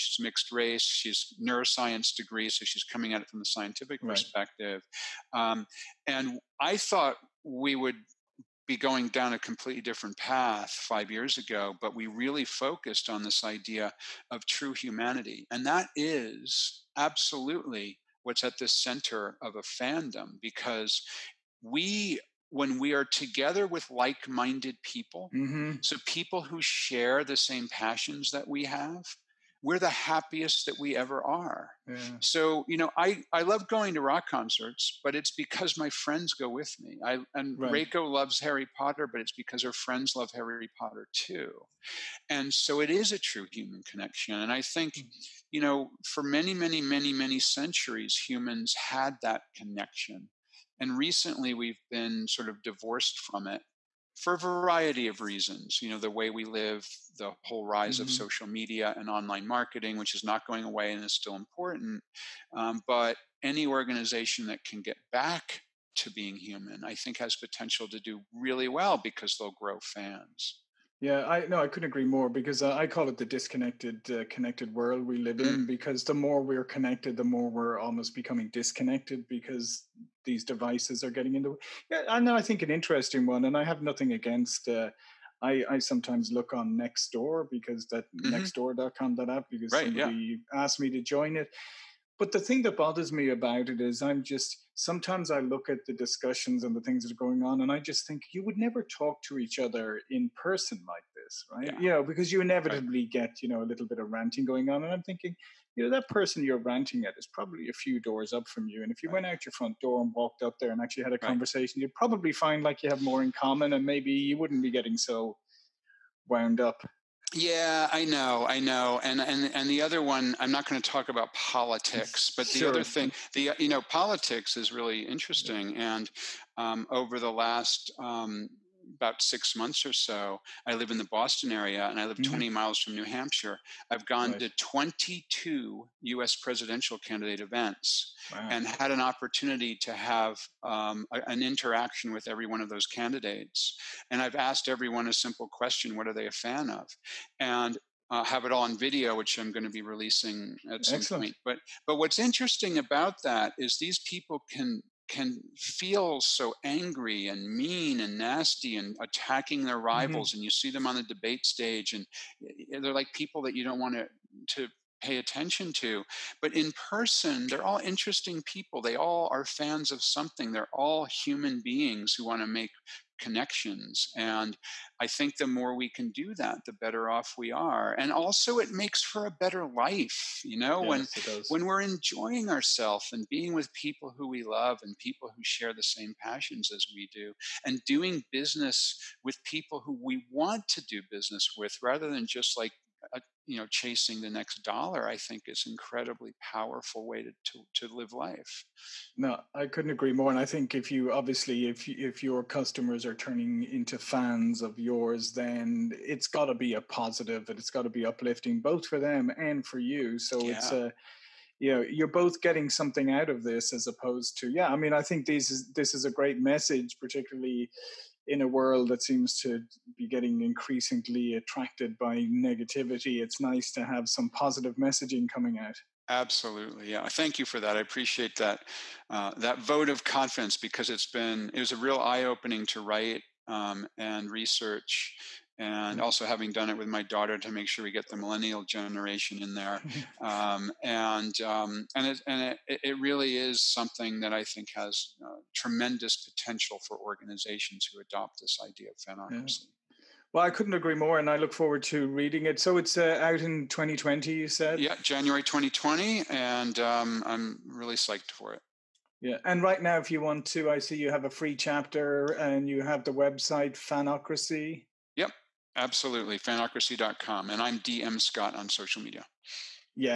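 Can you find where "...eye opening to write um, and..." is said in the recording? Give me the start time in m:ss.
3:51.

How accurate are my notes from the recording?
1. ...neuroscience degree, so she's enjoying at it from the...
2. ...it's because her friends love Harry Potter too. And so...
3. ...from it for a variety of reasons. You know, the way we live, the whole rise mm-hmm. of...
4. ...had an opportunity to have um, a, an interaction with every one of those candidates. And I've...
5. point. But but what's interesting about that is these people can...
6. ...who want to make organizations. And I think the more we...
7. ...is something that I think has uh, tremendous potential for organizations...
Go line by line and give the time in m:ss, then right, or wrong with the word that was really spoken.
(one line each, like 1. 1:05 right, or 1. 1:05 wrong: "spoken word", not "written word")
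1. 0:01 wrong: "coming", not "enjoying"
2. 0:39 right
3. 0:53 right
4. 2:18 right
5. 2:31 right
6. 2:52 wrong: "connections", not "organizations"
7. 4:03 right.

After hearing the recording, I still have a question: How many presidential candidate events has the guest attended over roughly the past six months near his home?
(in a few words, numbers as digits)
22.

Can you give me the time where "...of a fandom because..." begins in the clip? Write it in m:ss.
0:19.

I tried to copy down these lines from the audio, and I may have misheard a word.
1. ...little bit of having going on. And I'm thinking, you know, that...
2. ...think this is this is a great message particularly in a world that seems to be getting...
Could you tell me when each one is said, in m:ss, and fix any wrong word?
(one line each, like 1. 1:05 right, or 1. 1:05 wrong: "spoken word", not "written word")
1. 1:43 wrong: "ranting", not "having"
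2. 3:35 right.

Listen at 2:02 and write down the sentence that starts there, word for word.
other thing, the you know, politics is really interesting, and um, over the last um, about six months or so.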